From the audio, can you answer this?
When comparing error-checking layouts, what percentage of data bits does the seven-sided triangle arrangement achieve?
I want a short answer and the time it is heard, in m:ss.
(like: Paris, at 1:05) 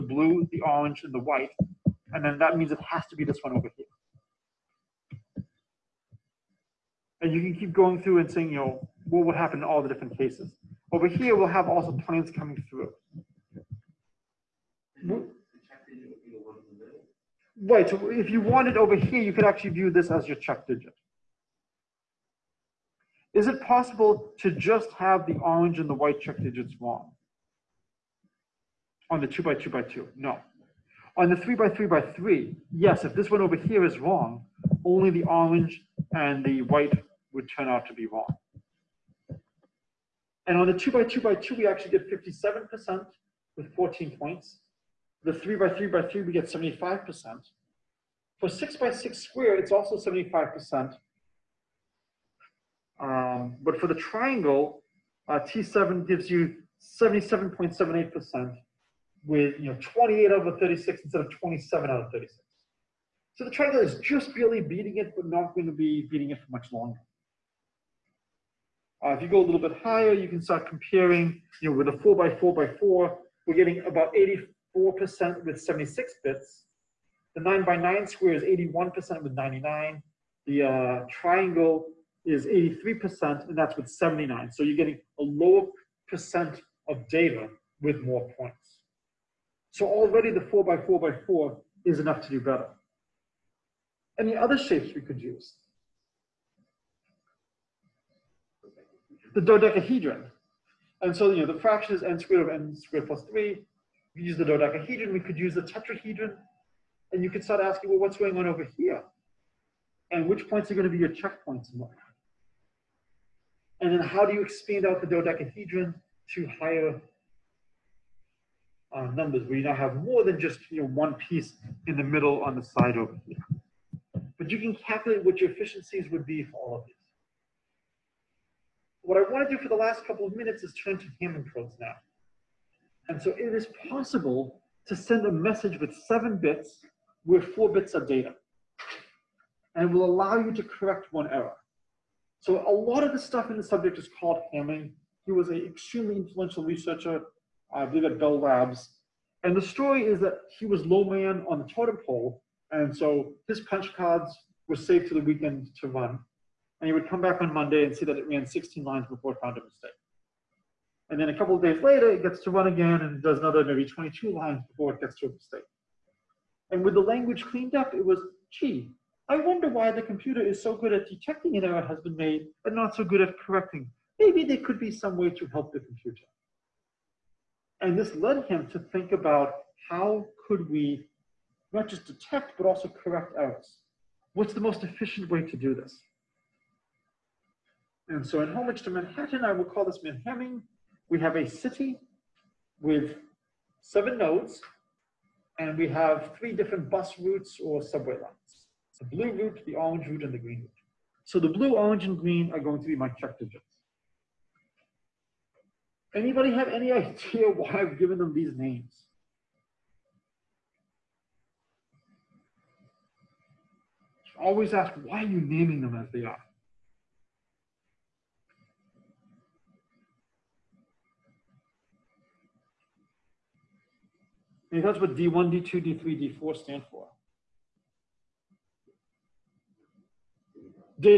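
77.78%, at 0:57.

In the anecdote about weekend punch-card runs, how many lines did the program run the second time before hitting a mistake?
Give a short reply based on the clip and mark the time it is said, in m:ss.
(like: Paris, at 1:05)
22, at 2:43.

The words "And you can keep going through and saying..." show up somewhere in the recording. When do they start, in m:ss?
0:07.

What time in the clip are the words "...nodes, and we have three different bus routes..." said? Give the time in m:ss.
3:14.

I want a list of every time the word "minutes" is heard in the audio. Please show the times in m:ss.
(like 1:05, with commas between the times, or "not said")
2:10.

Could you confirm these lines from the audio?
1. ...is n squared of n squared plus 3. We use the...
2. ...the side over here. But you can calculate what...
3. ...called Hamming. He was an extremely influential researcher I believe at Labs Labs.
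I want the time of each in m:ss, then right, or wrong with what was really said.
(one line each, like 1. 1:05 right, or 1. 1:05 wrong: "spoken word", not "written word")
1. 1:41 right
2. 2:02 right
3. 2:24 wrong: "Bell", not "Labs".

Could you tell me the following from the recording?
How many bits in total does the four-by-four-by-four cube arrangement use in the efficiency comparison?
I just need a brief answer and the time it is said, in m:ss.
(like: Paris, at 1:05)
76, at 1:15.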